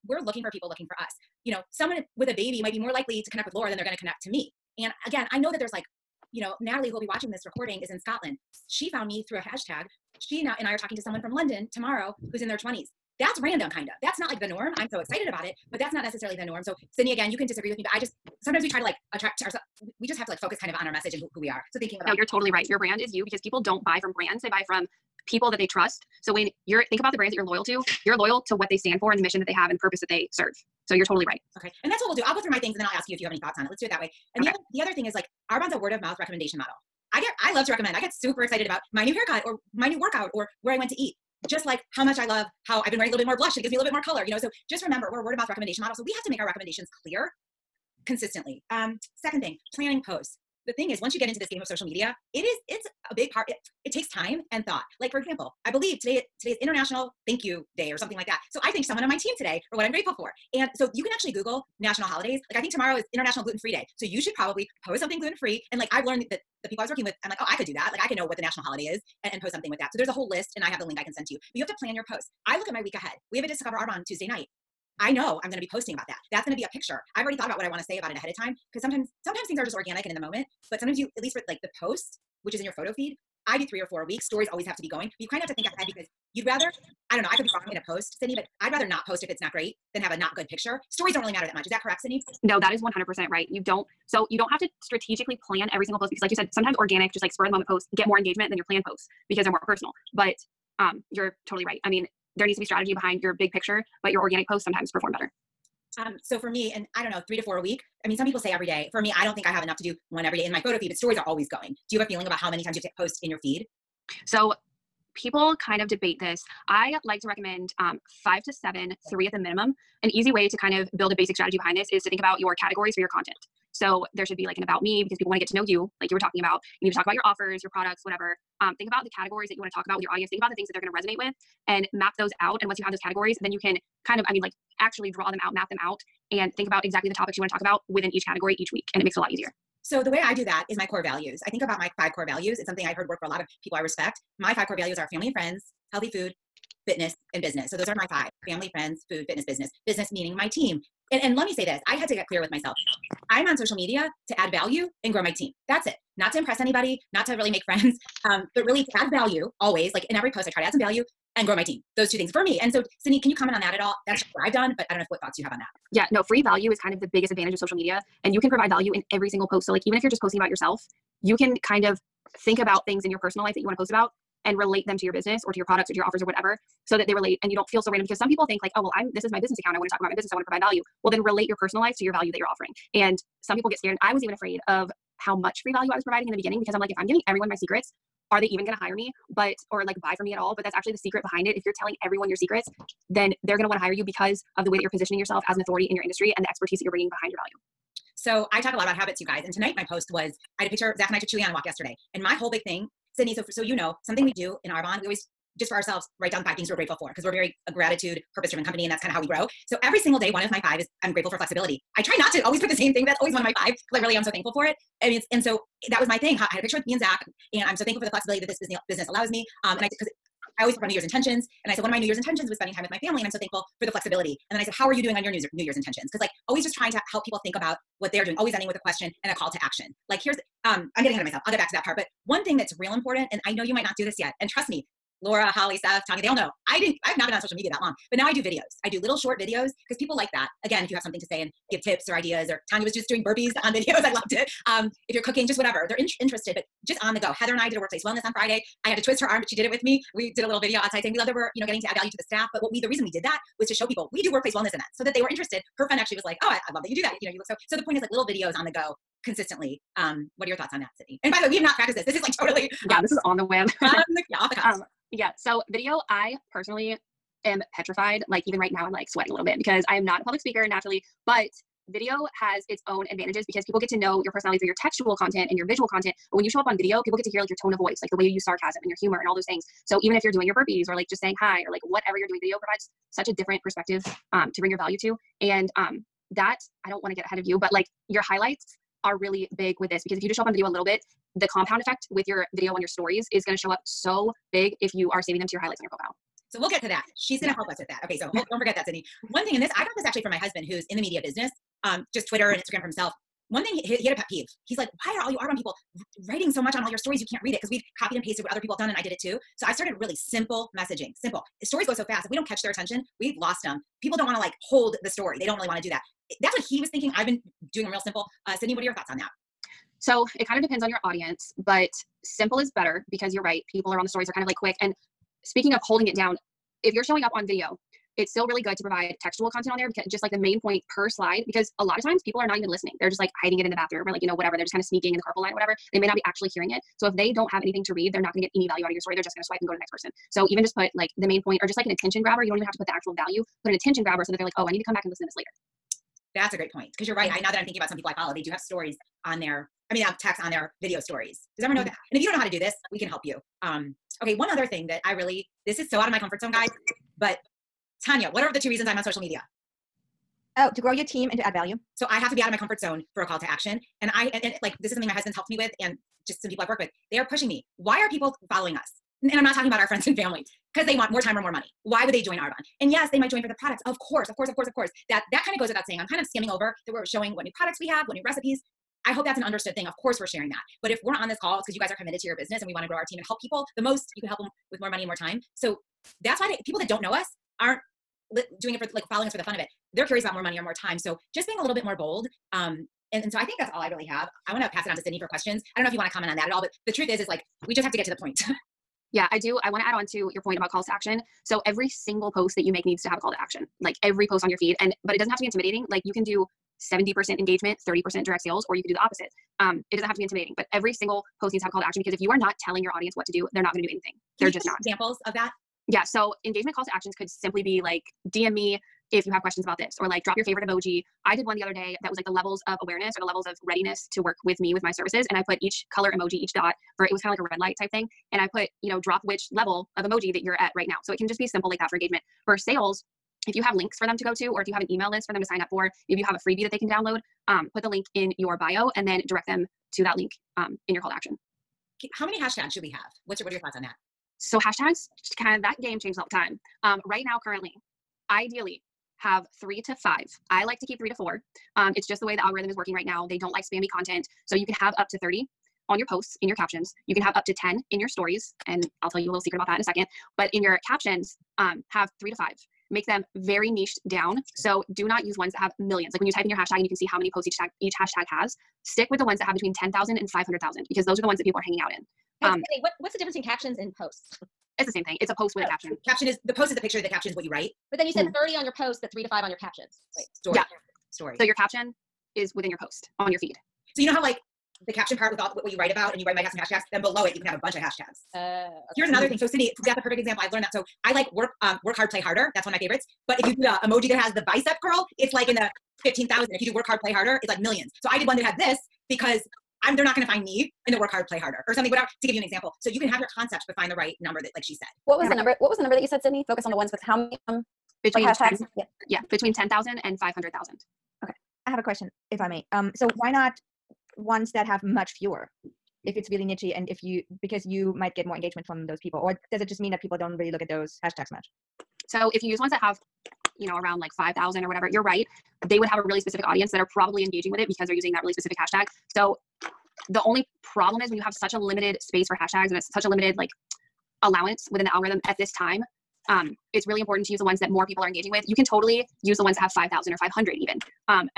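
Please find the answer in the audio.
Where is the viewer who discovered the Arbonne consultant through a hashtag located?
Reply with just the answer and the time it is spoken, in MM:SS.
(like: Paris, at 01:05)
Scotland, at 00:07.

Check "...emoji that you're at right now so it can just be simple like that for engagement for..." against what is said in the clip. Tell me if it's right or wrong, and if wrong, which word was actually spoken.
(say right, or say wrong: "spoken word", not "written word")
right.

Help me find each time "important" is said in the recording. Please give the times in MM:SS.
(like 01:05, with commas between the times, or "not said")
03:52, 08:57.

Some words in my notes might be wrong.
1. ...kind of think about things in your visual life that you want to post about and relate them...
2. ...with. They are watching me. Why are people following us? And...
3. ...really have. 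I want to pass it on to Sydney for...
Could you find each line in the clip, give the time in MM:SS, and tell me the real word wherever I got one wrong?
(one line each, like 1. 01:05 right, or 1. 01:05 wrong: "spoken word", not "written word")
1. 02:51 wrong: "personal", not "visual"
2. 06:06 wrong: "pushing", not "watching"
3. 06:33 right.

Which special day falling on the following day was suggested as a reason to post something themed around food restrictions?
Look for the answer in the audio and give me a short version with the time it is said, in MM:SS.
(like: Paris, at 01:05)
International Gluten Free Day, at 01:03.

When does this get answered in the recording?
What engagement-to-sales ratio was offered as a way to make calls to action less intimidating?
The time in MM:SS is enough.
06:46.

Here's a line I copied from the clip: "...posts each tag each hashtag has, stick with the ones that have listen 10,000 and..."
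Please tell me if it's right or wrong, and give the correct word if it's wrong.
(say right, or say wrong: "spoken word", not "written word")
wrong: "between", not "listen".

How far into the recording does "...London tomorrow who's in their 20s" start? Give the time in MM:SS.
00:11.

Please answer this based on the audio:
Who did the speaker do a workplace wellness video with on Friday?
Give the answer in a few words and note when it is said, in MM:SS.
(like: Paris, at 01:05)
Heather, at 04:07.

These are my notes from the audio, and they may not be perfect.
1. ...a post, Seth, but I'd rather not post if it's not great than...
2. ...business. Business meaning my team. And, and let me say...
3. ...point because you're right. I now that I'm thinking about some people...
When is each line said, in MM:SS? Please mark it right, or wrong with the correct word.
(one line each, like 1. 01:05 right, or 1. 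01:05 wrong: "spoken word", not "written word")
1. 01:27 wrong: "Sydney", not "Seth"
2. 02:29 right
3. 05:46 right.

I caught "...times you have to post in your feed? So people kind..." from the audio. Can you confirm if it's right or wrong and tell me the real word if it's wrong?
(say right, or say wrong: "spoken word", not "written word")
right.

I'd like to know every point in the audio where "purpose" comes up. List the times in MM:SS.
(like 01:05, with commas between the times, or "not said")
00:29, 03:28.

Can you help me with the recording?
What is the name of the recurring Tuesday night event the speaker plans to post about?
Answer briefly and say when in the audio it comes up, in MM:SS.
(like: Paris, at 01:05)
Discover Arbonne, at 01:13.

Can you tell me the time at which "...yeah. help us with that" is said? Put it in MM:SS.
04:57.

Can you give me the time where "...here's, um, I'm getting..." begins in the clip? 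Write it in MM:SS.
03:50.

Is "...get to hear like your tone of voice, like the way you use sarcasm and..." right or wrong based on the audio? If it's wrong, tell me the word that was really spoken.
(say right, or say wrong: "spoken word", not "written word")
right.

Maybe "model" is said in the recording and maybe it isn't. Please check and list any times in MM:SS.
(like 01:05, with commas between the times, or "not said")
00:36, 00:45.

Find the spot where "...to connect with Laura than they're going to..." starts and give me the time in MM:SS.
00:03.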